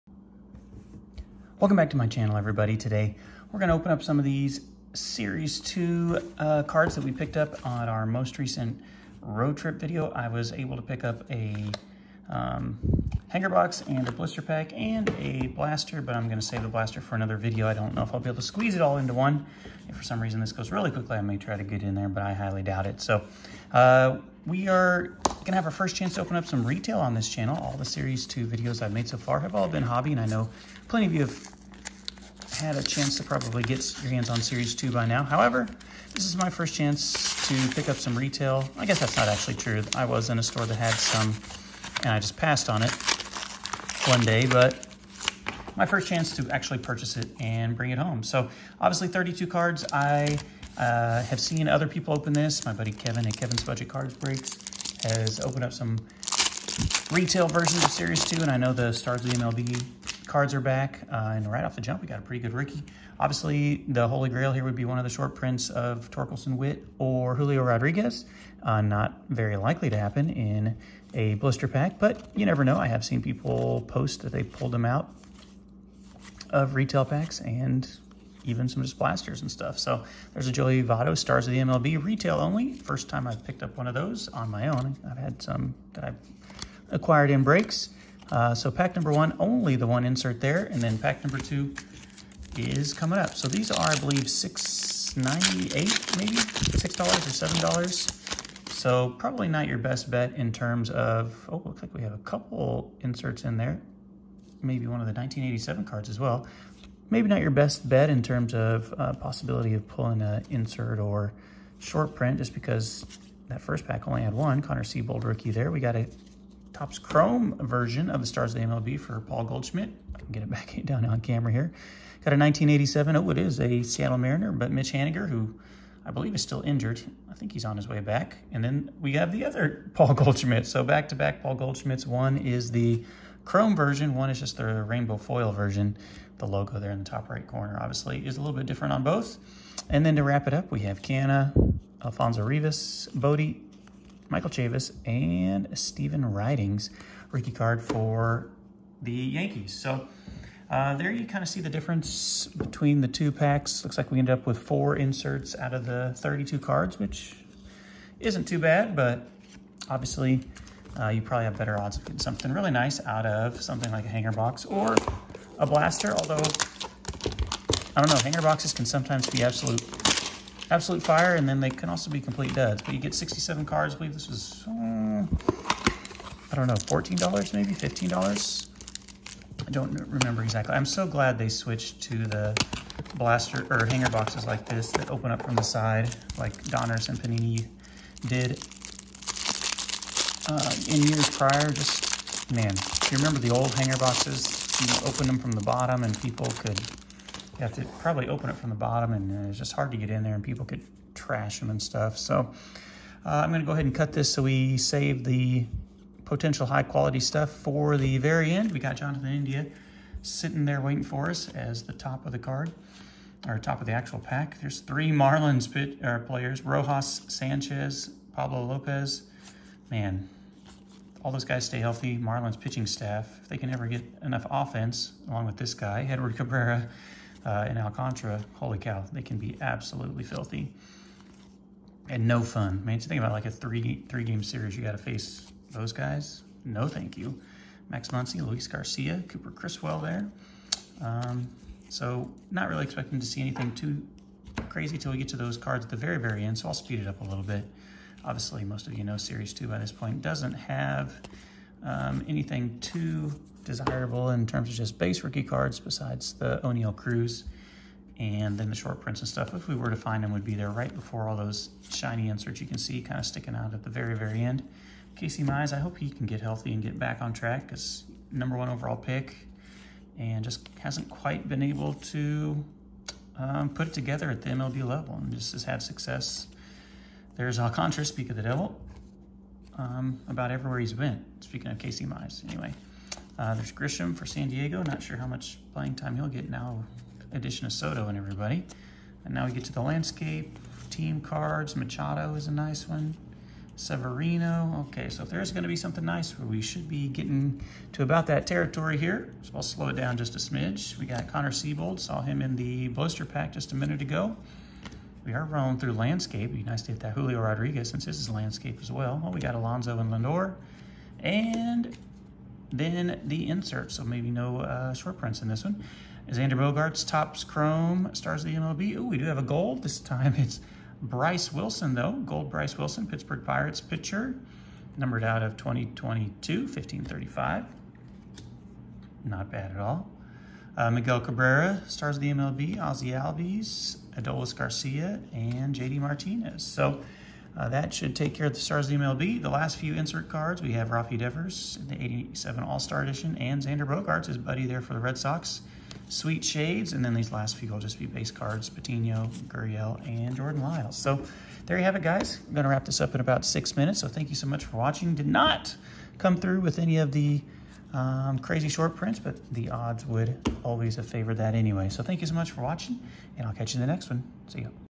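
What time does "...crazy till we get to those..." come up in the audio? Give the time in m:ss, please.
4:04.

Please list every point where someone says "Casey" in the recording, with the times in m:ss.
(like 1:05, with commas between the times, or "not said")
4:25, 4:41.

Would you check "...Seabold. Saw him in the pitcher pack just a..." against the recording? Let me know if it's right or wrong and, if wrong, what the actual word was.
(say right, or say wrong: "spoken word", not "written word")
wrong: "blister", not "pitcher".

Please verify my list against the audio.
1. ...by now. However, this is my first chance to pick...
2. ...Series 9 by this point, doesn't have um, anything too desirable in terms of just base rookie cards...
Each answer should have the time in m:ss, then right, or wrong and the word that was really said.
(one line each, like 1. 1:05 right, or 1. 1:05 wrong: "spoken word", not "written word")
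1. 0:34 right
2. 4:09 wrong: "2", not "9".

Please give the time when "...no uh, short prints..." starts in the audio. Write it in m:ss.
5:14.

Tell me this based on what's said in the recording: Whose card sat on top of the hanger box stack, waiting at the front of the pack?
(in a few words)
Jonathan India.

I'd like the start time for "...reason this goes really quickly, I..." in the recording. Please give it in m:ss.
0:20.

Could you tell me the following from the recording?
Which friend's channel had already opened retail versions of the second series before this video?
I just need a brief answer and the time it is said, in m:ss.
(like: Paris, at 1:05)
Kevin's Budget Cards Breaks, at 0:53.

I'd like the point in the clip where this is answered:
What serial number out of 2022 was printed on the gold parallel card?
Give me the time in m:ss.
5:26.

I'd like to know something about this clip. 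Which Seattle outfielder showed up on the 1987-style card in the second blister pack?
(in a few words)
Mitch Haniger.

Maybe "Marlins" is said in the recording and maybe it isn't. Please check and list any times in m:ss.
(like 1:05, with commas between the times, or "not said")
3:35, 3:42.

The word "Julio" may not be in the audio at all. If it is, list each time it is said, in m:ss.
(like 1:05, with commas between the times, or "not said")
1:07, 5:07.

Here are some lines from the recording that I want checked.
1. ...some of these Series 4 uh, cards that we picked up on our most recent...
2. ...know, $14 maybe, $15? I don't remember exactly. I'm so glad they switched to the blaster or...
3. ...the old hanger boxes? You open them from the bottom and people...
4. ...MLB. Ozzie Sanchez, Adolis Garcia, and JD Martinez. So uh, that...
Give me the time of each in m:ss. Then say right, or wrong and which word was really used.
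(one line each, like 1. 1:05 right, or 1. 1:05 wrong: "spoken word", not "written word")
1. 0:04 wrong: "2", not "4"
2. 2:56 right
3. 3:13 right
4. 5:32 wrong: "Albies", not "Sanchez".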